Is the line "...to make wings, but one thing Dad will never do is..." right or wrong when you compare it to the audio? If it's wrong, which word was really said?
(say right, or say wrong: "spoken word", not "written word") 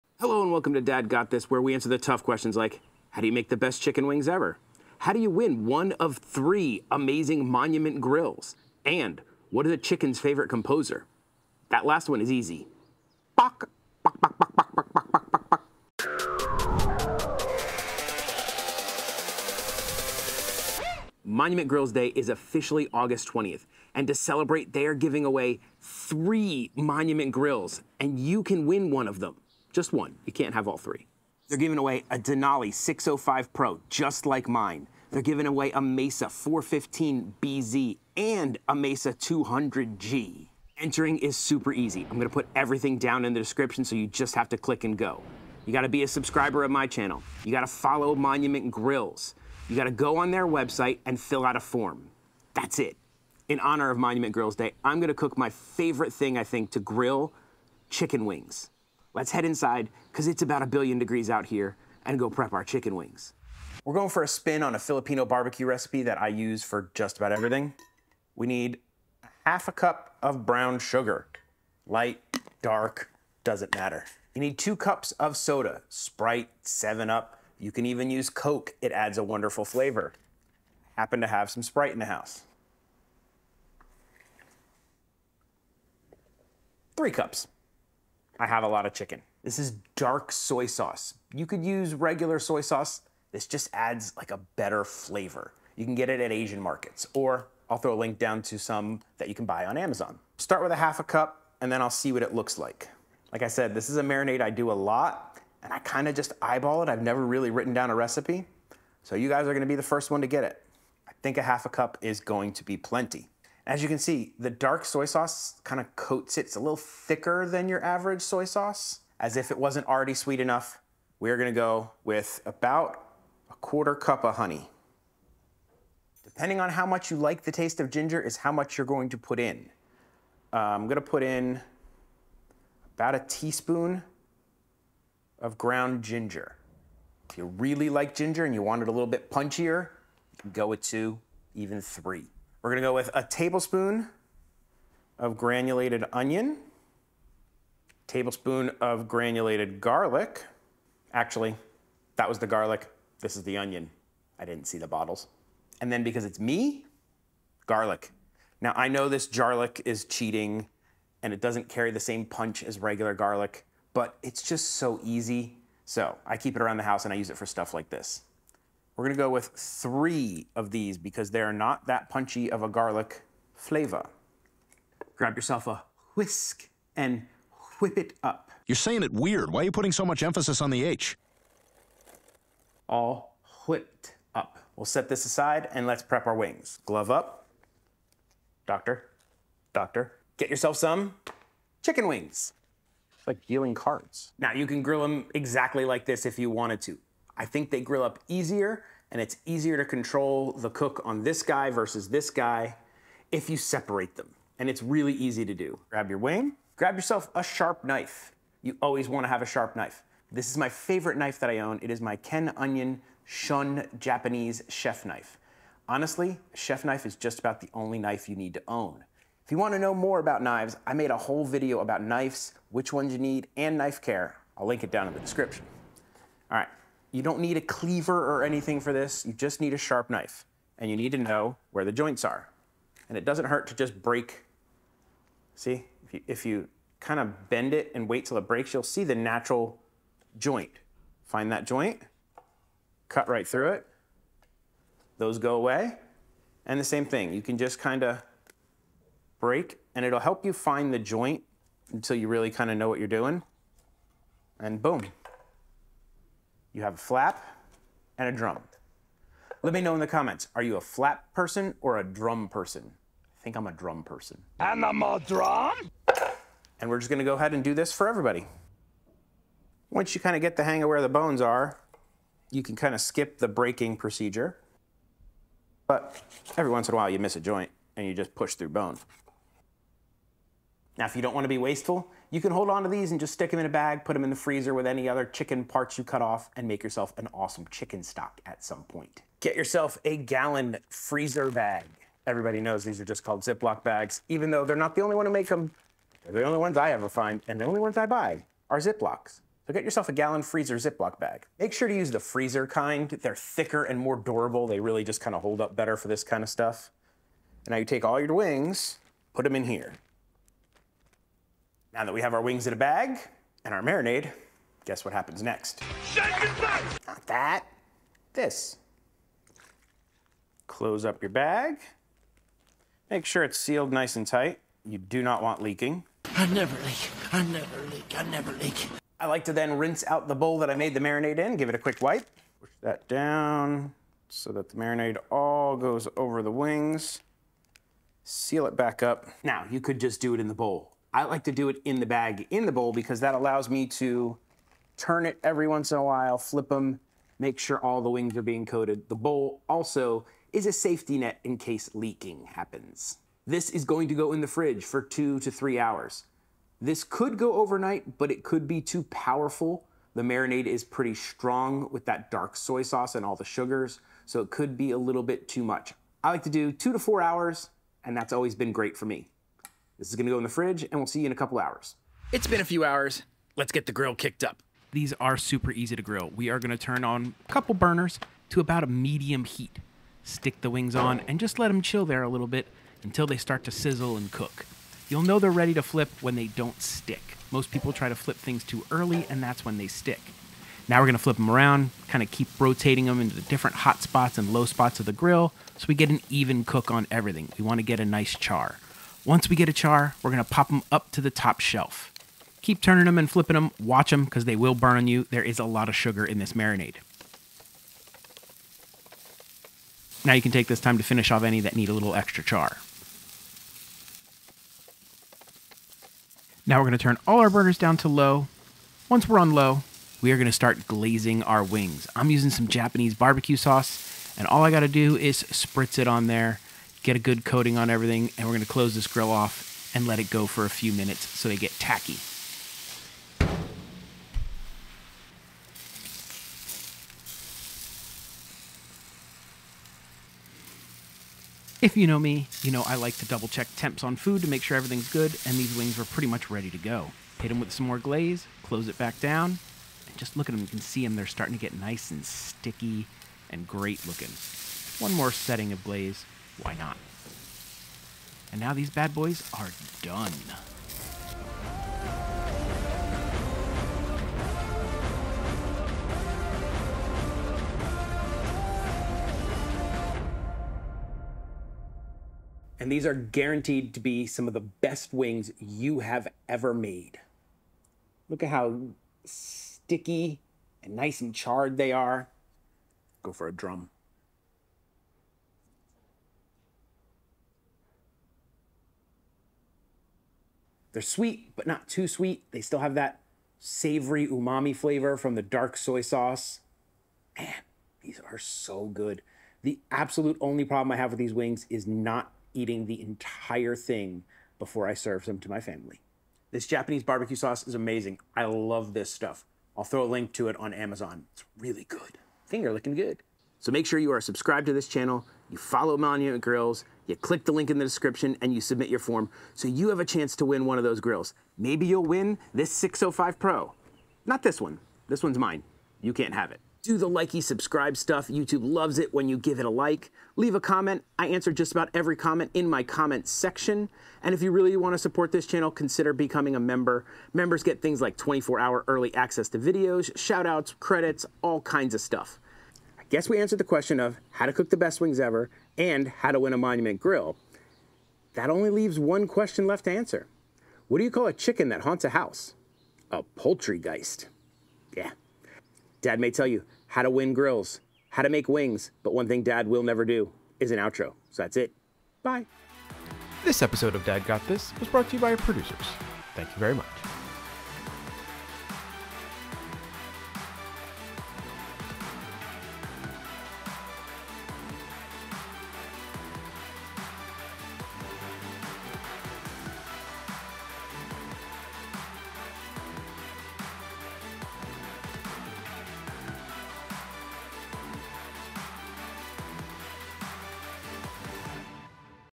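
right.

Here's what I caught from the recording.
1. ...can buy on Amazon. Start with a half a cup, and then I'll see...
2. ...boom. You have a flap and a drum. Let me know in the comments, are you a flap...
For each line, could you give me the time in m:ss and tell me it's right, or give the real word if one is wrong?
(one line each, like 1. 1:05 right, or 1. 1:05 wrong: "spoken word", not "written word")
1. 1:39 right
2. 4:14 right.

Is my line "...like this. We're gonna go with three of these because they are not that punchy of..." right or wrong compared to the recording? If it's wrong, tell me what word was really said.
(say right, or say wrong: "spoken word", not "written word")
right.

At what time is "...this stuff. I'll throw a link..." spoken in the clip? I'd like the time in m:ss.
8:28.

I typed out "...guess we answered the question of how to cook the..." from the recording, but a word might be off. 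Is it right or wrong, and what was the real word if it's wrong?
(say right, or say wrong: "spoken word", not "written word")
right.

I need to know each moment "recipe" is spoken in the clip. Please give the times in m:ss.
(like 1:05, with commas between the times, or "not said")
1:05, 1:47.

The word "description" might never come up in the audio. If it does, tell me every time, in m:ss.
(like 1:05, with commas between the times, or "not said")
0:43, 3:45, 8:37.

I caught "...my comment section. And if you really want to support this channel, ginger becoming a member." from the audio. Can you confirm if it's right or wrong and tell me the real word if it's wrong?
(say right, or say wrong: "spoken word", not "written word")
wrong: "consider", not "ginger".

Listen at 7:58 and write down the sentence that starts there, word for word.
Look at how sticky and nice and charred they are.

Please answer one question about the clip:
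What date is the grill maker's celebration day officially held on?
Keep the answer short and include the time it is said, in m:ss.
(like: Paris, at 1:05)
August 20th, at 0:22.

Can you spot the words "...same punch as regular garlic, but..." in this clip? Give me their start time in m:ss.
2:41.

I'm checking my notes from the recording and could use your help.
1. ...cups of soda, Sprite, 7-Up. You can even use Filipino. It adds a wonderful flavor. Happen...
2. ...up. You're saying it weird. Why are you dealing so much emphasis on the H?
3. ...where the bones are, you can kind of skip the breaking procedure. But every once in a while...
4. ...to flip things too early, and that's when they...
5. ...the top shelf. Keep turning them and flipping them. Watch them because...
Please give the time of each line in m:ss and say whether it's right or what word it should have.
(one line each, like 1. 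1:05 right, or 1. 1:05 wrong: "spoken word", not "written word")
1. 1:14 wrong: "Coke", not "Filipino"
2. 2:58 wrong: "putting", not "dealing"
3. 4:30 right
4. 6:28 right
5. 6:41 right.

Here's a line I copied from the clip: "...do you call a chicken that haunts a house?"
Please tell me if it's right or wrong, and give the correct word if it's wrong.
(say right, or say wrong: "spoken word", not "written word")
right.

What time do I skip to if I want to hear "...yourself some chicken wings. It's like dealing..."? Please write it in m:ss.
3:10.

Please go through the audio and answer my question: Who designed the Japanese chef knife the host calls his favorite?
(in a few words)
Ken Onion.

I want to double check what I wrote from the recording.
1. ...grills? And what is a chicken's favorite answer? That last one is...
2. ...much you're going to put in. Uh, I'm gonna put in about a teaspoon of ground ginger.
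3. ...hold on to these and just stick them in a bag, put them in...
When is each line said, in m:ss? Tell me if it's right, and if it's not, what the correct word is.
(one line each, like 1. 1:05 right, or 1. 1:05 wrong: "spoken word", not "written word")
1. 0:08 wrong: "composer", not "answer"
2. 2:08 right
3. 4:42 right.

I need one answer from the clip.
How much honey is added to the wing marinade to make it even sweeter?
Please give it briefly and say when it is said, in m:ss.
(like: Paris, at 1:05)
a quarter cup, at 2:02.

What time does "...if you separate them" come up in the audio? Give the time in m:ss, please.
3:23.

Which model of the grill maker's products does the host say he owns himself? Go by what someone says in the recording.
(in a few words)
Denali 605 Pro.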